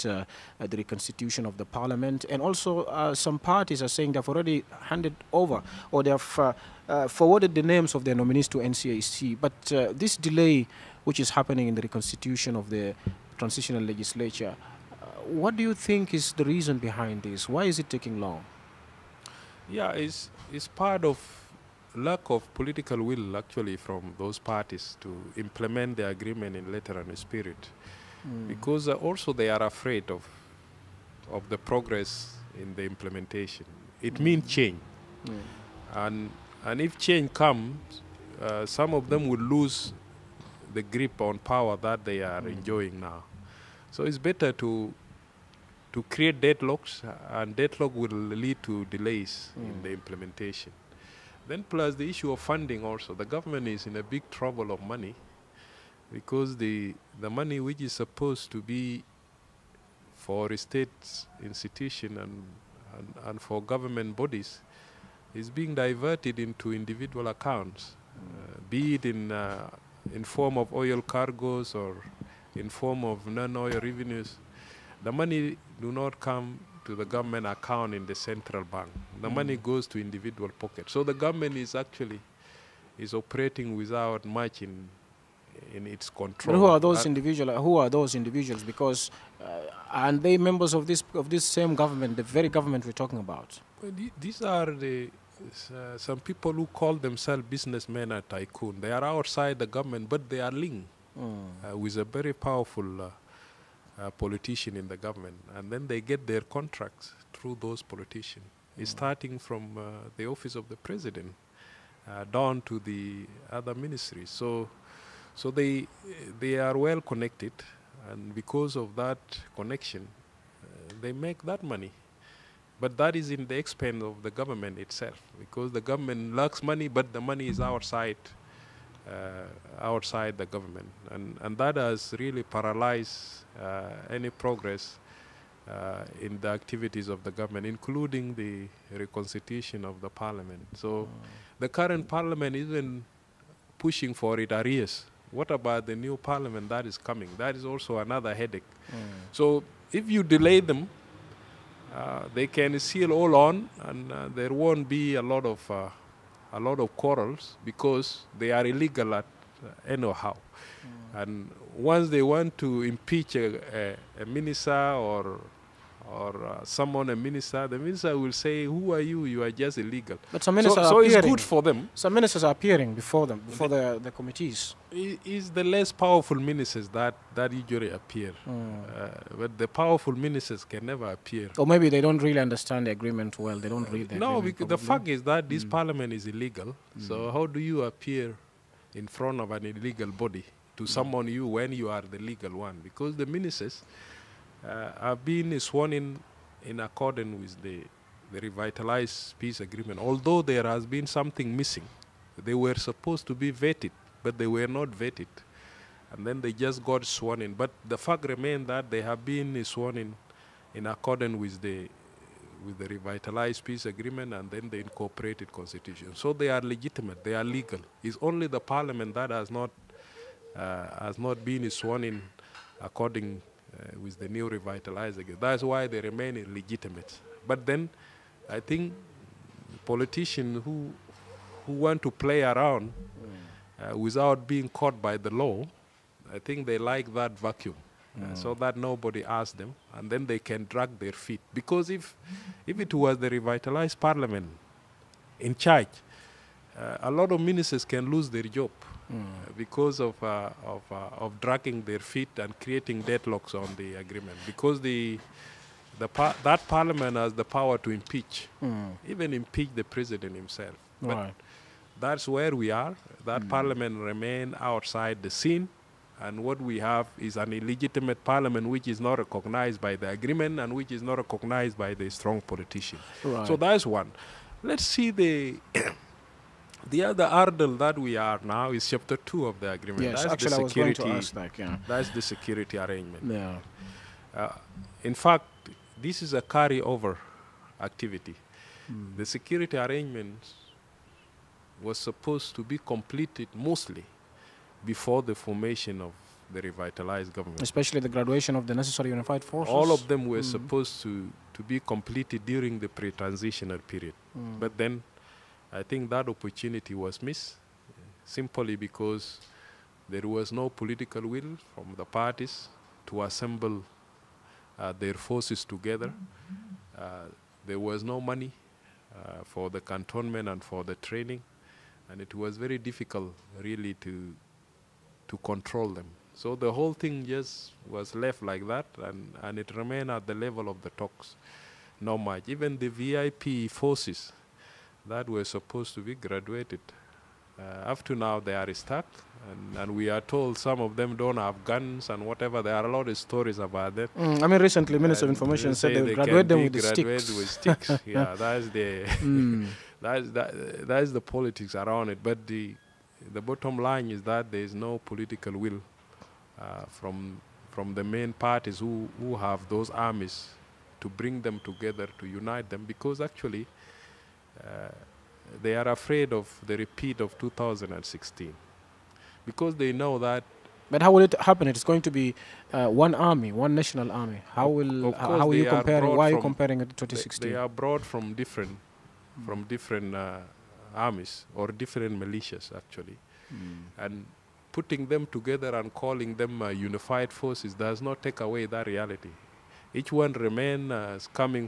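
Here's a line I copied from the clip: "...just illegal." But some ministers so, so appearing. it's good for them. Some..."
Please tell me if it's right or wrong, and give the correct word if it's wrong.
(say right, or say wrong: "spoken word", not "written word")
right.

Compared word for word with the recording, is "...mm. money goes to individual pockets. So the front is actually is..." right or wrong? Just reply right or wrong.
wrong.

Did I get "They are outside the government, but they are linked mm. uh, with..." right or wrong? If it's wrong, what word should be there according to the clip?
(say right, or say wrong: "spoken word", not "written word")
right.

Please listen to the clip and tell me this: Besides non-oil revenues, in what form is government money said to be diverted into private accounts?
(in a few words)
oil cargoes.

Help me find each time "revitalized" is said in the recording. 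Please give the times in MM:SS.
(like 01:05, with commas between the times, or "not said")
03:18, 03:32, 03:44, 04:03, 04:56.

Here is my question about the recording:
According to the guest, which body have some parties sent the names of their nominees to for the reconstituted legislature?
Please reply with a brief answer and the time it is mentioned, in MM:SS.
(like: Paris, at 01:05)
NCAC, at 00:08.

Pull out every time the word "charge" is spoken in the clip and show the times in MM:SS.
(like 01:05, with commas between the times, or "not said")
04:05.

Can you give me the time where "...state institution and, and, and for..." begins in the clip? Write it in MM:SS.
01:00.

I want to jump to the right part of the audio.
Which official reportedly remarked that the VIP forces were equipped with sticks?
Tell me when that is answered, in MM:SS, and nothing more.
05:44.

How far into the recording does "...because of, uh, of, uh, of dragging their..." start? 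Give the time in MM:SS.
04:09.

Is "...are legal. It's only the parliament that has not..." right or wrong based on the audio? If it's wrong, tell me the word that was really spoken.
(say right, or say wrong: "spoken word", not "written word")
right.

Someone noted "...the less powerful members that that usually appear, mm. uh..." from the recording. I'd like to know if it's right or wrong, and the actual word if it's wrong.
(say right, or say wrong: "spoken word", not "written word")
wrong: "ministers", not "members".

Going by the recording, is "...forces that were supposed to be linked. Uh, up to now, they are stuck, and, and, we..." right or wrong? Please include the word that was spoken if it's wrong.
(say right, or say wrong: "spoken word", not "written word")
wrong: "graduated", not "linked".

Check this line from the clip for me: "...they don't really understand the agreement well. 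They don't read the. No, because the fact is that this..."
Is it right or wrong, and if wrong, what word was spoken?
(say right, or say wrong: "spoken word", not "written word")
right.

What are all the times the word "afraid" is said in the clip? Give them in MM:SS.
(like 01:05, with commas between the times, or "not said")
00:29, 06:05.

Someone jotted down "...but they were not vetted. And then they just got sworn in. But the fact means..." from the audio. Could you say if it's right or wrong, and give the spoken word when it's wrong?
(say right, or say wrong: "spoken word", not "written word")
wrong: "remains", not "means".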